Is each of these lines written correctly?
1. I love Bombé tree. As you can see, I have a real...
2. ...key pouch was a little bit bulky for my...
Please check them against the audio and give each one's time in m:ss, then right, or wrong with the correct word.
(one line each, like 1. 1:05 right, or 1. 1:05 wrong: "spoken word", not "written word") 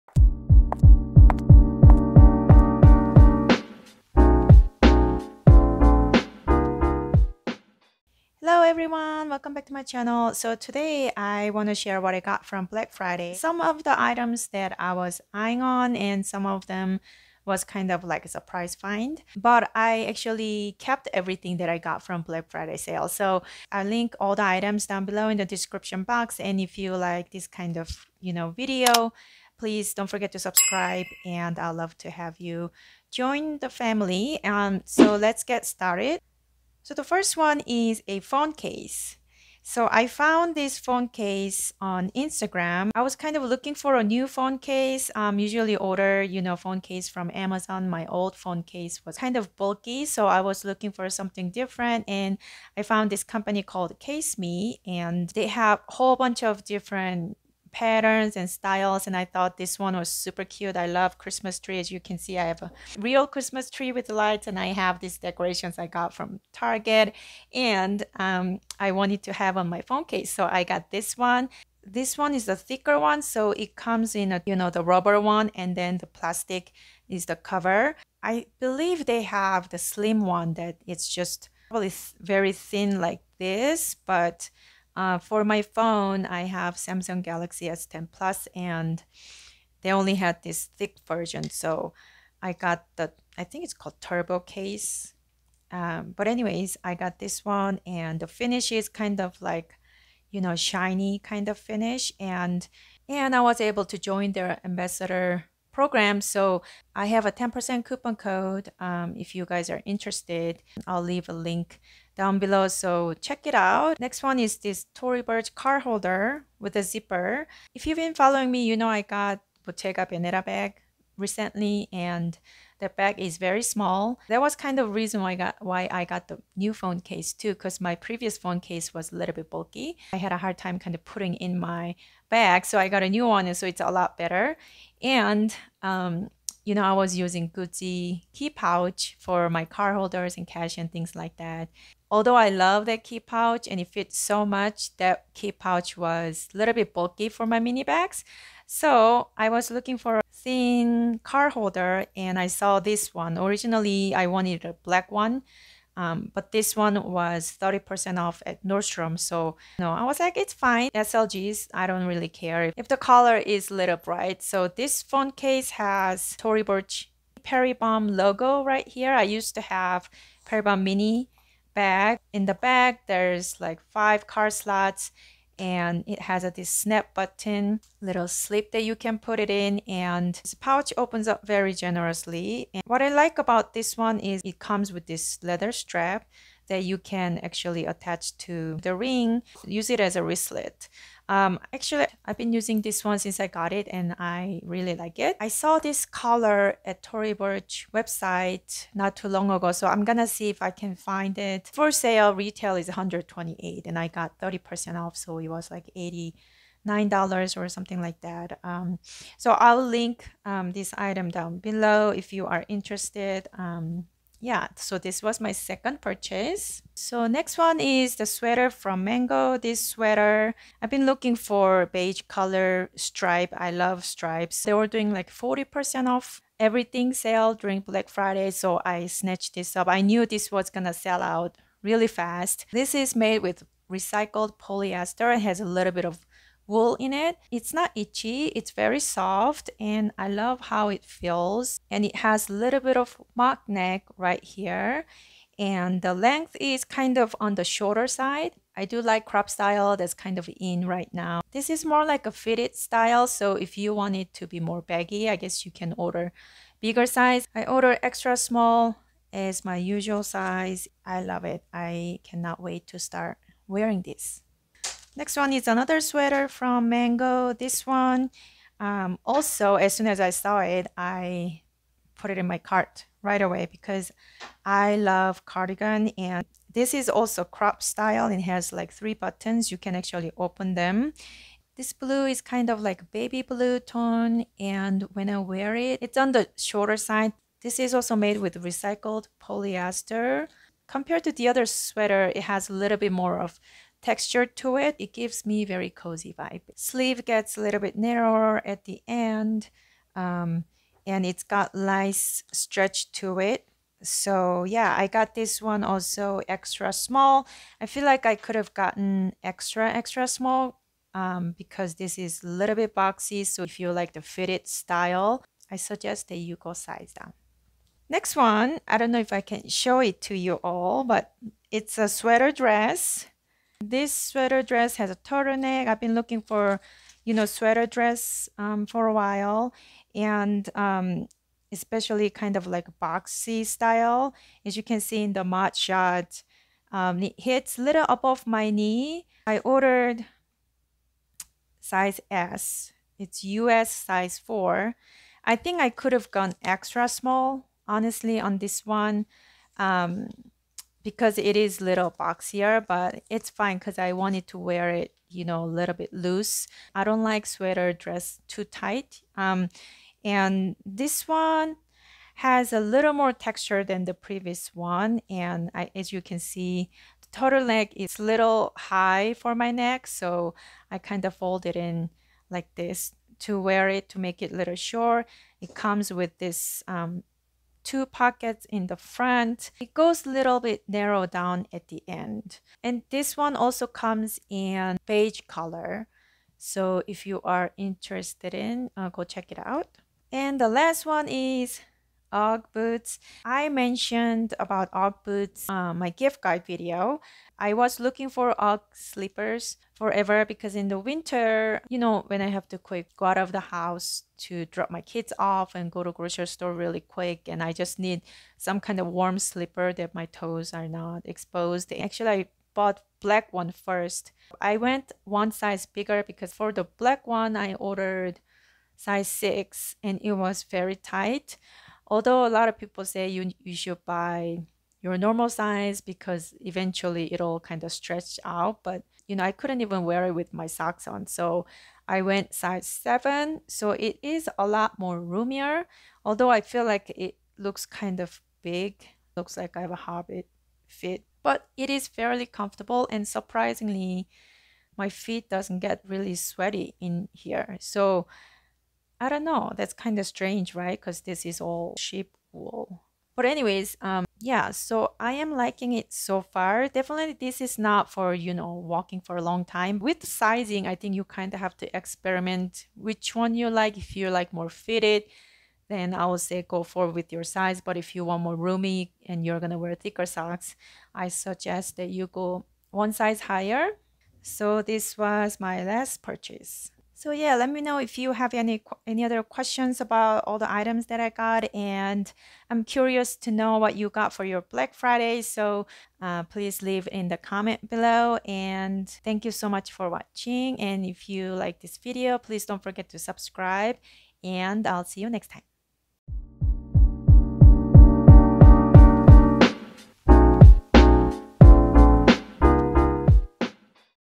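1. 1:00 wrong: "Christmas", not "Bombé"
2. 2:25 right.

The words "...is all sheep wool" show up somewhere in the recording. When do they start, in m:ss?
7:31.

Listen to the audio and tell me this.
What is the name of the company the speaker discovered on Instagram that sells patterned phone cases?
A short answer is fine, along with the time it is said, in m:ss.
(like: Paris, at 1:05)
Kaseme, at 0:53.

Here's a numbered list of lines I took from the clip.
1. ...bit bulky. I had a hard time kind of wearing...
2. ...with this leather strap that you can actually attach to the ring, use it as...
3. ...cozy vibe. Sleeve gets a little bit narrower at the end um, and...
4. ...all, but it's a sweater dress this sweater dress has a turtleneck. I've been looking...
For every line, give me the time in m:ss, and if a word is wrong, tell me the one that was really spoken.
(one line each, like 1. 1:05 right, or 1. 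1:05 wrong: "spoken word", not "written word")
1. 2:09 wrong: "putting", not "wearing"
2. 3:04 right
3. 4:55 right
4. 5:20 right.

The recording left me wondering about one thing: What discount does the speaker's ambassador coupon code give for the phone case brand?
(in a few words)
10%.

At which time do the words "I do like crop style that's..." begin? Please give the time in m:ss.
4:08.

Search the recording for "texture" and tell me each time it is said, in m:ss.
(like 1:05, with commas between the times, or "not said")
4:54, 6:03.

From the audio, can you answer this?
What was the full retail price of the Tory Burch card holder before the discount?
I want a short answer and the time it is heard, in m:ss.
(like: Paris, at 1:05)
128, at 3:22.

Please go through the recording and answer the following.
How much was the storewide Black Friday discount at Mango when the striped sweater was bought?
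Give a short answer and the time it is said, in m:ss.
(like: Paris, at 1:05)
40%, at 3:45.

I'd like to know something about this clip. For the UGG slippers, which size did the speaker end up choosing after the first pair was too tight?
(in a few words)
7.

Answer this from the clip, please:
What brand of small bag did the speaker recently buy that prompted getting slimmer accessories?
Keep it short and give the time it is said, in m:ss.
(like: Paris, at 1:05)
Bottega Veneta, at 1:59.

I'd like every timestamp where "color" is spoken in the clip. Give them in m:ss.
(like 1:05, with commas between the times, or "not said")
2:42, 3:16, 3:42, 6:25.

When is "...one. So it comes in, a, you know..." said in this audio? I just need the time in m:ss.
1:12.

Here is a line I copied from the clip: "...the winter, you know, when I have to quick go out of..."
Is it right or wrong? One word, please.
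right.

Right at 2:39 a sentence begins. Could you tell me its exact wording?
So you know, I was like, it's fine.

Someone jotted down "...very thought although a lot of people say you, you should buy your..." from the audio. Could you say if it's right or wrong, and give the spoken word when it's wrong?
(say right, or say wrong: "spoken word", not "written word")
wrong: "tight", not "thought".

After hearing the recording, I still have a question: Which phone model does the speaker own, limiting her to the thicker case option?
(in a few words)
Samsung Galaxy S10 Plus.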